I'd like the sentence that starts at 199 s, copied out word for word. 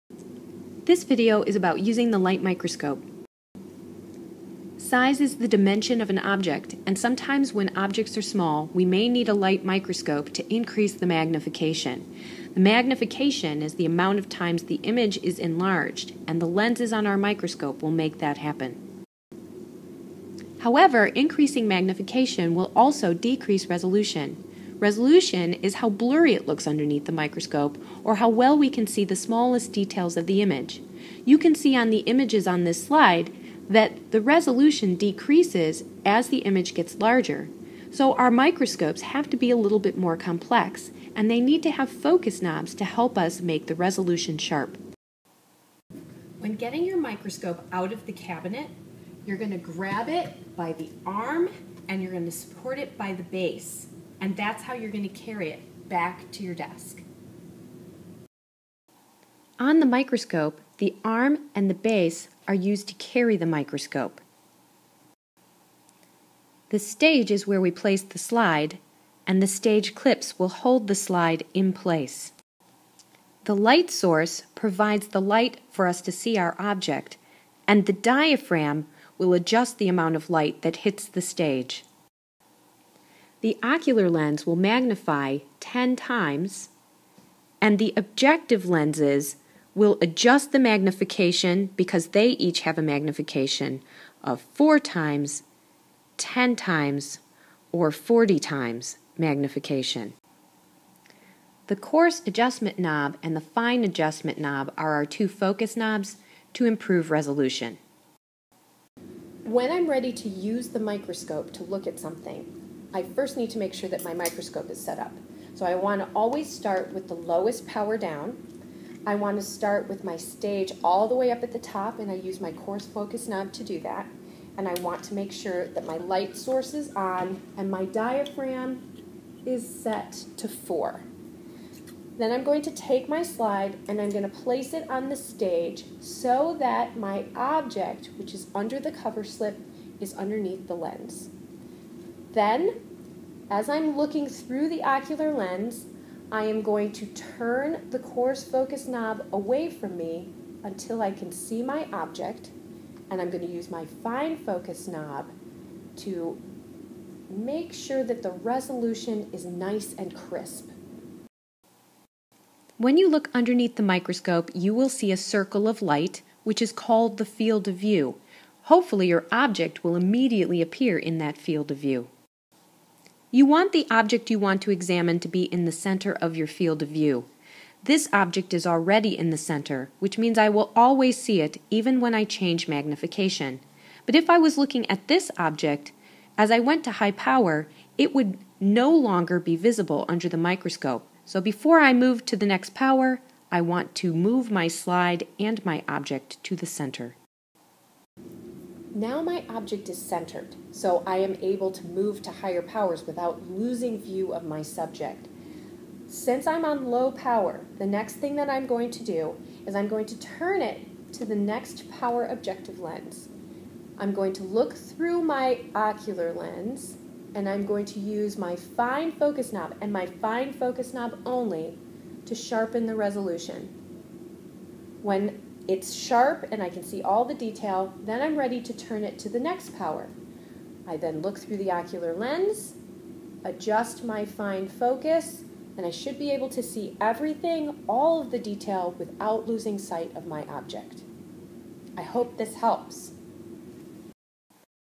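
Now my object is centered, so I am able to move to higher powers without losing view of my subject.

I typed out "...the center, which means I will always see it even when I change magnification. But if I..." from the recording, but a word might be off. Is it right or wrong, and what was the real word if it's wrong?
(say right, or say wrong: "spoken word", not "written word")
right.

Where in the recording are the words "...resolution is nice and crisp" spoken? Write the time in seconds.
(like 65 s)
158 s.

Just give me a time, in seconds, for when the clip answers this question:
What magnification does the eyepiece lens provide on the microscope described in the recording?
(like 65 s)
84 s.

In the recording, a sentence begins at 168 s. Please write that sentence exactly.
Hopefully, your object will immediately appear in that field of view.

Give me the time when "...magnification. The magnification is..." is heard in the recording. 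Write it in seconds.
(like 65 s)
11 s.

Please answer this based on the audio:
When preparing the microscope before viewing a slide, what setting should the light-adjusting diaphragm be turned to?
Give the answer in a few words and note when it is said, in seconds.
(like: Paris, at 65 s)
4, at 129 s.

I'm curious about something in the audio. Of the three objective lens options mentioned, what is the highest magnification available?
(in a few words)
40 times.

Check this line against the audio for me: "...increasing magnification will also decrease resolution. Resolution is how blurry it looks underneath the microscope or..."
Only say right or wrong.
right.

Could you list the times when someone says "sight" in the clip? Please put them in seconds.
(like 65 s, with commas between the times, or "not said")
239 s.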